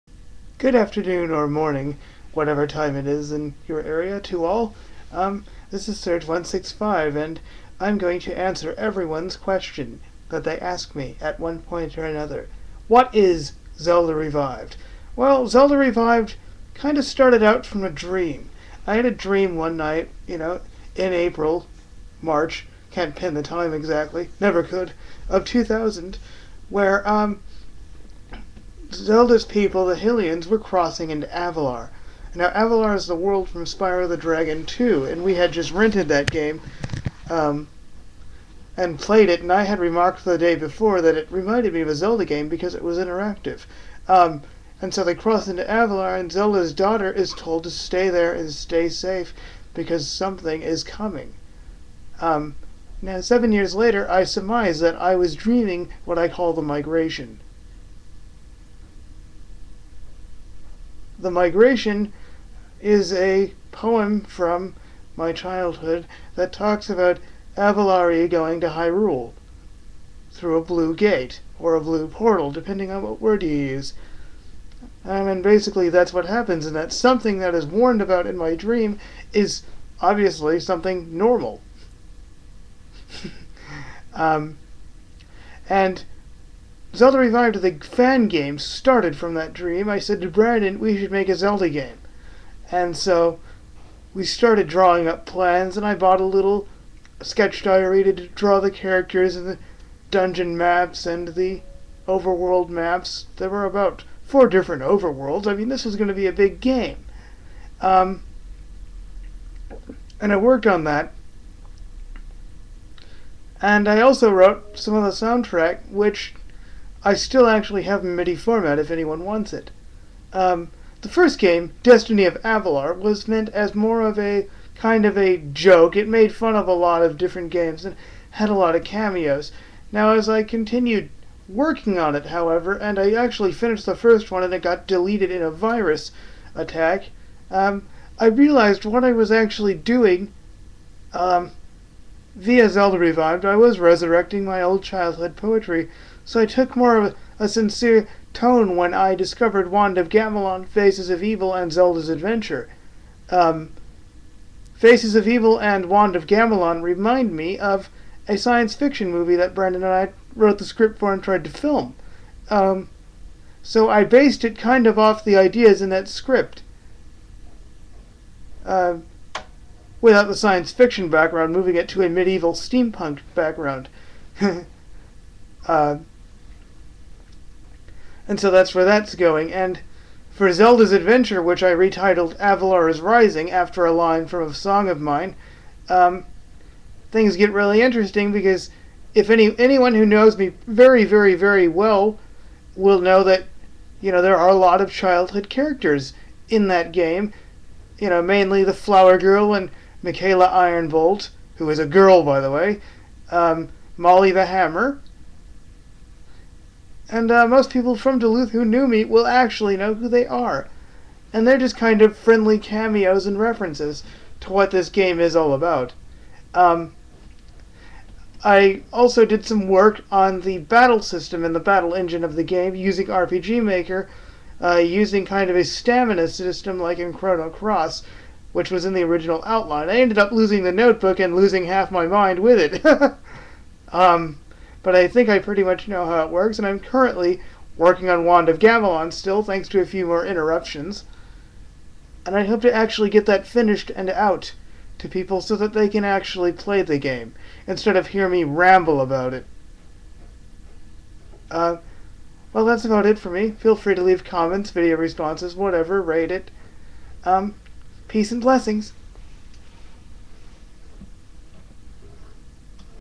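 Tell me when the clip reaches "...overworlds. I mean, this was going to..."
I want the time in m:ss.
1:44.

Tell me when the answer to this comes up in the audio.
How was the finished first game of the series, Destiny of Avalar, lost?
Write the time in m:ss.
2:14.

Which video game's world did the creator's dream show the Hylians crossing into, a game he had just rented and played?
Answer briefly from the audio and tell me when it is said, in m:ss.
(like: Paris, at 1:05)
Spyro the Dragon 2, at 0:33.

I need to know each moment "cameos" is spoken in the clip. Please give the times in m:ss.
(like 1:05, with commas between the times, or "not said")
2:08, 3:32.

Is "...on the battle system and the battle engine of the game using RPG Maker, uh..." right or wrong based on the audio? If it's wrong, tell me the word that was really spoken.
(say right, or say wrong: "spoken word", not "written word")
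right.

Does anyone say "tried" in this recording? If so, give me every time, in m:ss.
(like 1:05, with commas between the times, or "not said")
2:41.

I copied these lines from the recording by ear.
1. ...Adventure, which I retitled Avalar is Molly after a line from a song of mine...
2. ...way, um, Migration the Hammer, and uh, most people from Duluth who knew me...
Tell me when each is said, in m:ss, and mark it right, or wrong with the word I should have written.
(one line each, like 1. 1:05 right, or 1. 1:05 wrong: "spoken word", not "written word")
1. 3:00 wrong: "Rising", not "Molly"
2. 3:22 wrong: "Molly", not "Migration".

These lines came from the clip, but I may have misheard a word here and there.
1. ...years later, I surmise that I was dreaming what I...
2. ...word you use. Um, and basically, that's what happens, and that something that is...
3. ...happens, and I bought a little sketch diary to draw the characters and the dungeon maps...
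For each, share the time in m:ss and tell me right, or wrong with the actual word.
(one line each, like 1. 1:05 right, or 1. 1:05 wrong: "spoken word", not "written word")
1. 0:53 right
2. 1:13 right
3. 1:35 wrong: "plans", not "happens".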